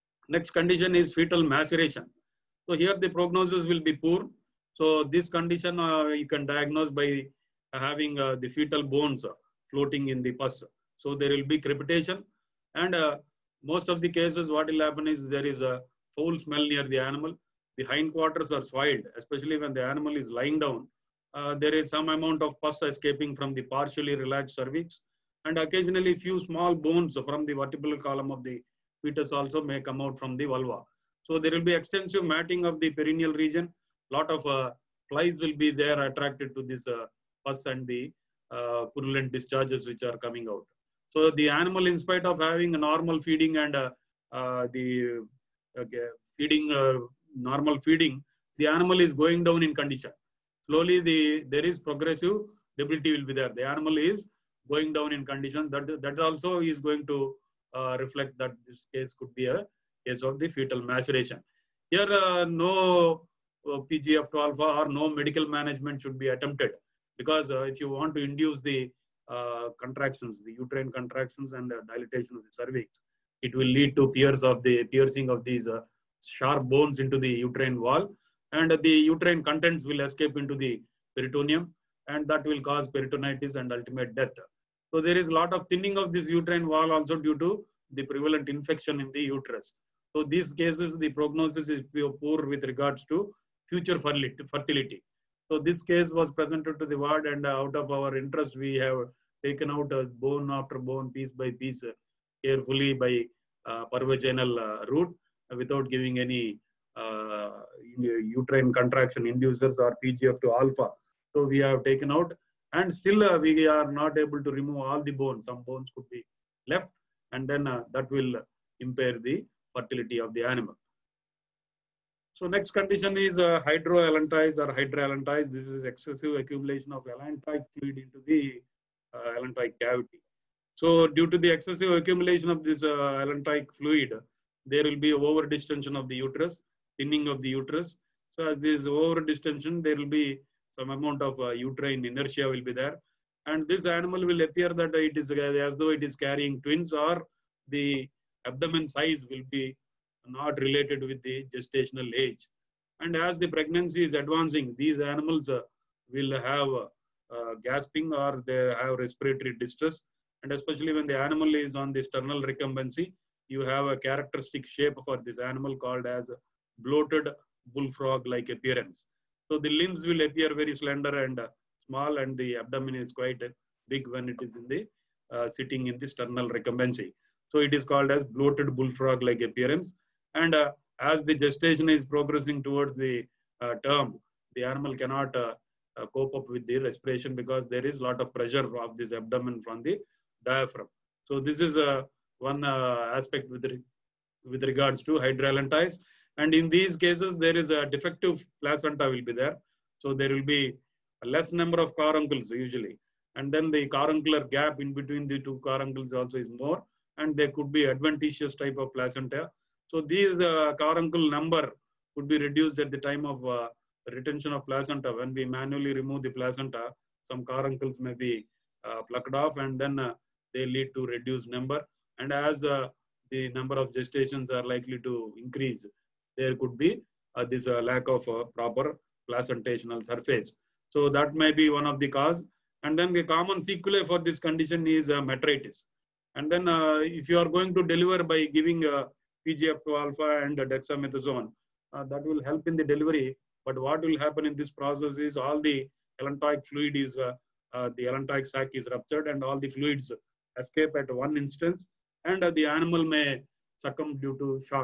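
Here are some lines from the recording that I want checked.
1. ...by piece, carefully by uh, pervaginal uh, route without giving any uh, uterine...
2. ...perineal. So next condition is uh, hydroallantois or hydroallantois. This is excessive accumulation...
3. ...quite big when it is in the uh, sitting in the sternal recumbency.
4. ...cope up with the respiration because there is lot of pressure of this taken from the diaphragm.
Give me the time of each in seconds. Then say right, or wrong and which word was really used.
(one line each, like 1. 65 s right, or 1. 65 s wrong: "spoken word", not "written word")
1. 101 s right
2. 120 s wrong: "animal", not "perineal"
3. 173 s right
4. 186 s wrong: "abdomen", not "taken".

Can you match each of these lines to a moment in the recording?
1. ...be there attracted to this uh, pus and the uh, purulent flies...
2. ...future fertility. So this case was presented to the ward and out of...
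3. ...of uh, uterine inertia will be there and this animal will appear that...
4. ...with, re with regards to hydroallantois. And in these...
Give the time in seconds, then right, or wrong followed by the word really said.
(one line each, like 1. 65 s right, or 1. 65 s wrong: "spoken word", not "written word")
1. 35 s wrong: "discharges", not "flies"
2. 93 s right
3. 141 s right
4. 193 s right.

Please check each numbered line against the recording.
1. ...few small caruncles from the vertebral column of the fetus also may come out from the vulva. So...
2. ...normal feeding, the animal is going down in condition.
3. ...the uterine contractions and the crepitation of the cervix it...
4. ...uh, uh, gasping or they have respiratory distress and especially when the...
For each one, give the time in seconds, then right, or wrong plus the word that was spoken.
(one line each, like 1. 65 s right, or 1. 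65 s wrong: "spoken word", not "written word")
1. 26 s wrong: "bones", not "caruncles"
2. 47 s right
3. 70 s wrong: "dilatation", not "crepitation"
4. 156 s right.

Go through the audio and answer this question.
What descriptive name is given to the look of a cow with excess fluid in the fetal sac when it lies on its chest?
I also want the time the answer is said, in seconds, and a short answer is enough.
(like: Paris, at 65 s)
Bloated bullfrog-like appearance, at 166 s.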